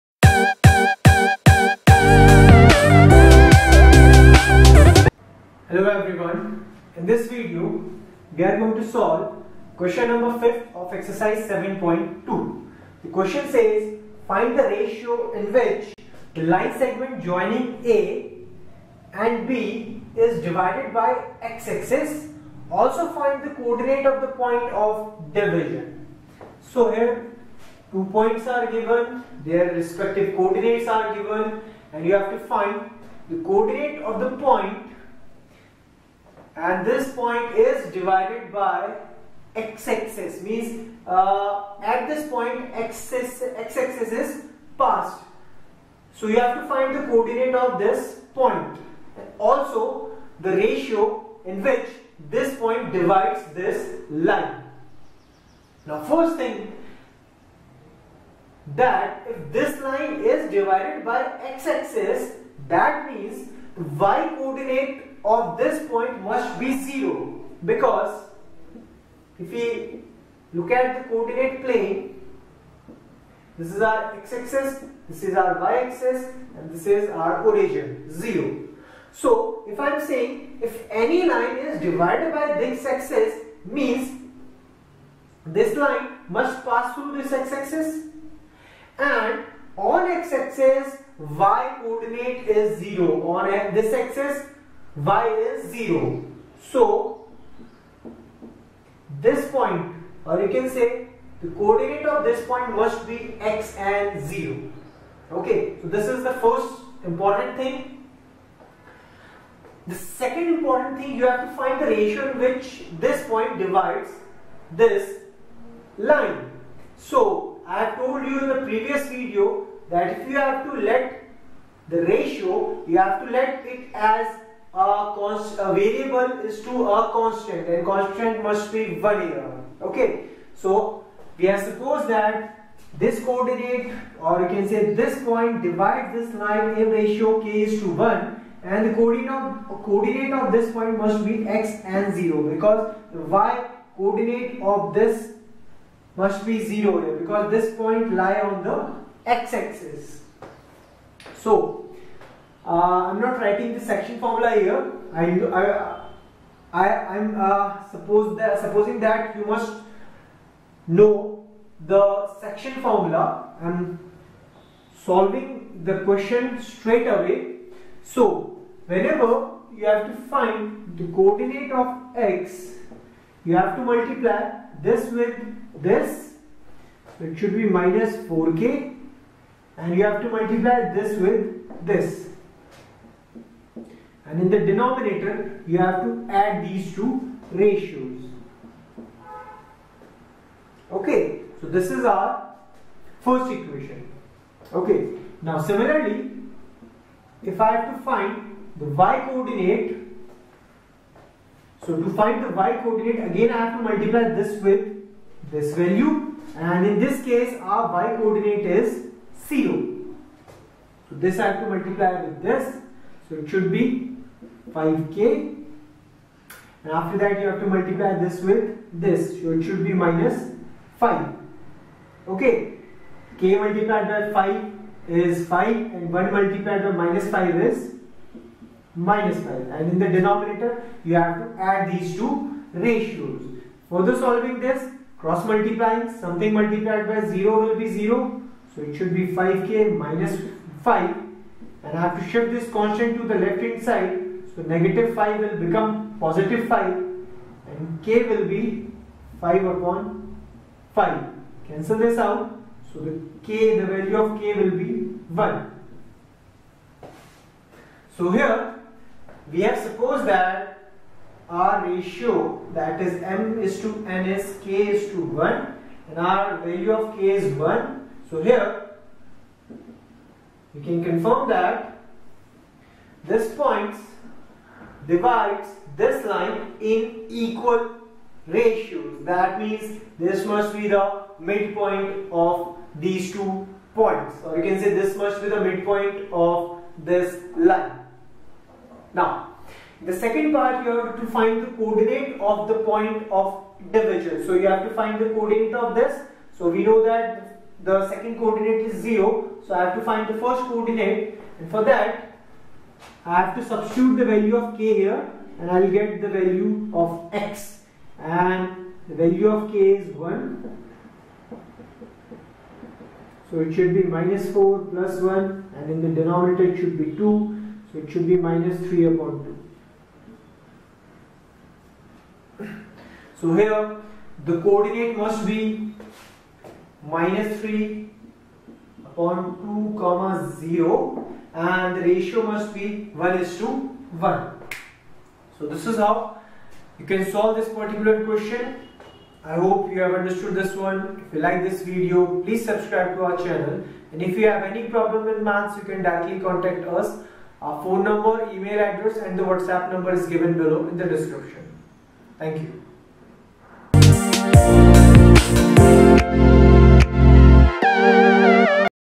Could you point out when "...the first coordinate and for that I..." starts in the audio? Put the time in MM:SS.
05:00.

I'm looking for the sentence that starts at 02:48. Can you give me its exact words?
So whenever you have to find the coordinate of x, you have to multiply this with this.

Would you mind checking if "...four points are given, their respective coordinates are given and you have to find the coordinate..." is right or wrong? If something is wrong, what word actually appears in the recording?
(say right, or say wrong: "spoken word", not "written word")
wrong: "two", not "four".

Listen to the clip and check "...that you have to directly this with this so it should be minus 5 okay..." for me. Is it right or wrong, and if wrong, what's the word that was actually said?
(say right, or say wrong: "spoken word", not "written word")
wrong: "multiply", not "directly".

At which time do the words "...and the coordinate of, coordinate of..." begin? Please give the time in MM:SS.
02:18.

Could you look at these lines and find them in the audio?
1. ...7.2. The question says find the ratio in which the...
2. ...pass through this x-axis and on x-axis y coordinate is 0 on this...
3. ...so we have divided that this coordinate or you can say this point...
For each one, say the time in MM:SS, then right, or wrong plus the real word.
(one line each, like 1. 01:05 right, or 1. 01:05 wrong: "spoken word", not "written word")
1. 00:11 right
2. 01:26 right
3. 02:10 wrong: "supposed", not "divided".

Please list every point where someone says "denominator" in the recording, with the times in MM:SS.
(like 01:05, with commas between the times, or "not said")
03:04, 03:50, 05:16.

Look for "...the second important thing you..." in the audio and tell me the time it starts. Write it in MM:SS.
01:49.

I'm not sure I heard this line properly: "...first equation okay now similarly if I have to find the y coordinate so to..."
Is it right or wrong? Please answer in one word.
right.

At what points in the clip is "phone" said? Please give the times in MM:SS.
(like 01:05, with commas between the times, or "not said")
05:47.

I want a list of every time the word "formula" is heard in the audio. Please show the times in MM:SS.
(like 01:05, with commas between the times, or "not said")
02:34, 02:42.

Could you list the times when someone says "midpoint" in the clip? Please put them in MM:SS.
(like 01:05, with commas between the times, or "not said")
04:41, 04:45.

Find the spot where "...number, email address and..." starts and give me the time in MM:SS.
05:48.